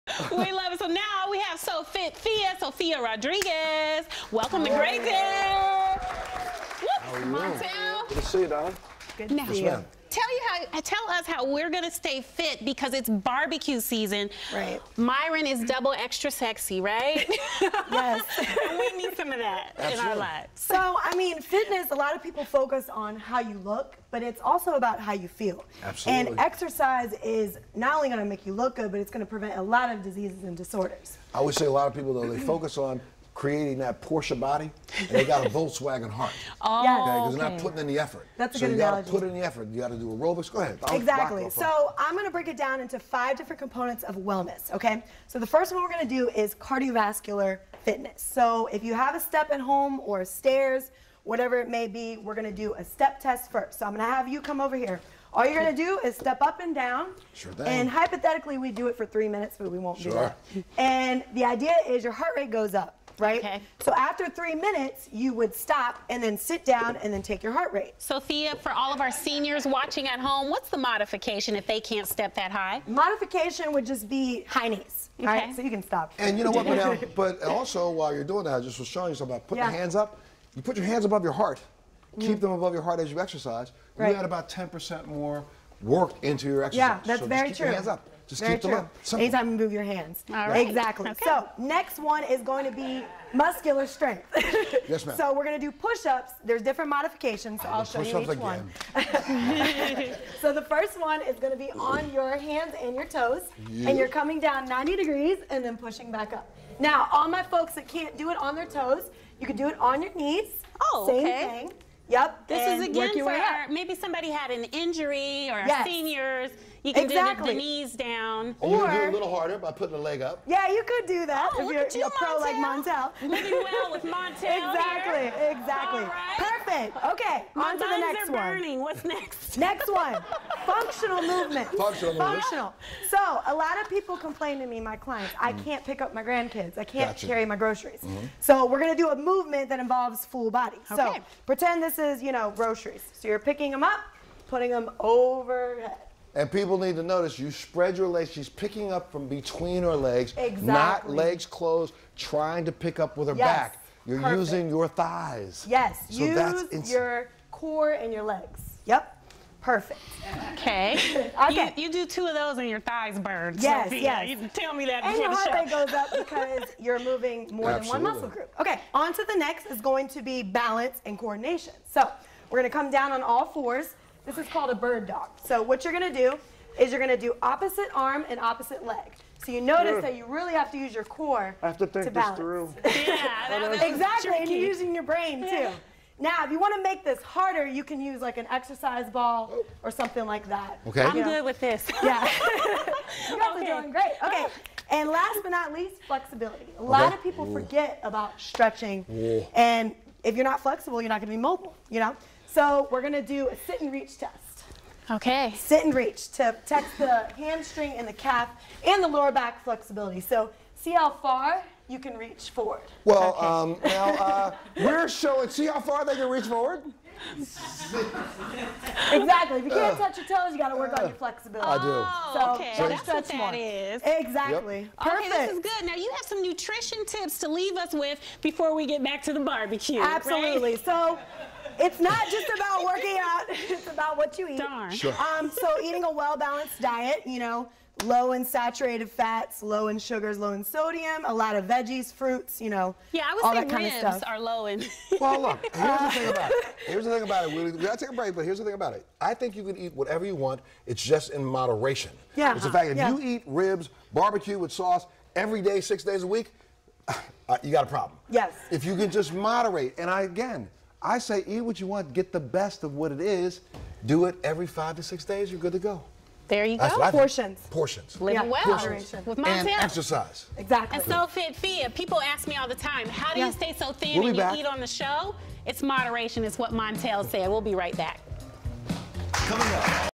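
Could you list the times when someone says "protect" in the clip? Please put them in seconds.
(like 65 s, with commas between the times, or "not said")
206 s.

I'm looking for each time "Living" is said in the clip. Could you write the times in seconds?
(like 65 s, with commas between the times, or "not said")
123 s, 268 s.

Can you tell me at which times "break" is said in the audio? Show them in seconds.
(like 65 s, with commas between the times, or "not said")
42 s, 248 s.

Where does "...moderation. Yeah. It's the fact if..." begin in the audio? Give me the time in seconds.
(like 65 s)
251 s.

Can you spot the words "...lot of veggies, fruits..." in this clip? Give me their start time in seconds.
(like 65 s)
241 s.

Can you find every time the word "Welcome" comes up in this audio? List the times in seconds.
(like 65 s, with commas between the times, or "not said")
4 s.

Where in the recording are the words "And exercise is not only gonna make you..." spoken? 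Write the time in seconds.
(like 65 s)
26 s.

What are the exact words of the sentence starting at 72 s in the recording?
Modification would just be high knees.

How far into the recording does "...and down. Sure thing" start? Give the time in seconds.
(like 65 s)
56 s.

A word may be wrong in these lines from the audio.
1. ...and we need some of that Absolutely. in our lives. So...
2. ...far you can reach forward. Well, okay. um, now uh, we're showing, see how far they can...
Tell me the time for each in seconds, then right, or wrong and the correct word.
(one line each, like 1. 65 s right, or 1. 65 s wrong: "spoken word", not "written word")
1. 18 s right
2. 211 s right.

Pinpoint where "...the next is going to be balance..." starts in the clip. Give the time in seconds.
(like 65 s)
169 s.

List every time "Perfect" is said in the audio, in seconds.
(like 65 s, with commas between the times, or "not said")
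126 s, 154 s, 159 s, 224 s.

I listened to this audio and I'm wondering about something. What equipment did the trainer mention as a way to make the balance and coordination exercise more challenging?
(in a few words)
exercise ball.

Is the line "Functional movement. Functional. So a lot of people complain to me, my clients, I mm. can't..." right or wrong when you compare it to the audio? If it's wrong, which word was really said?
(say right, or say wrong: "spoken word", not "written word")
right.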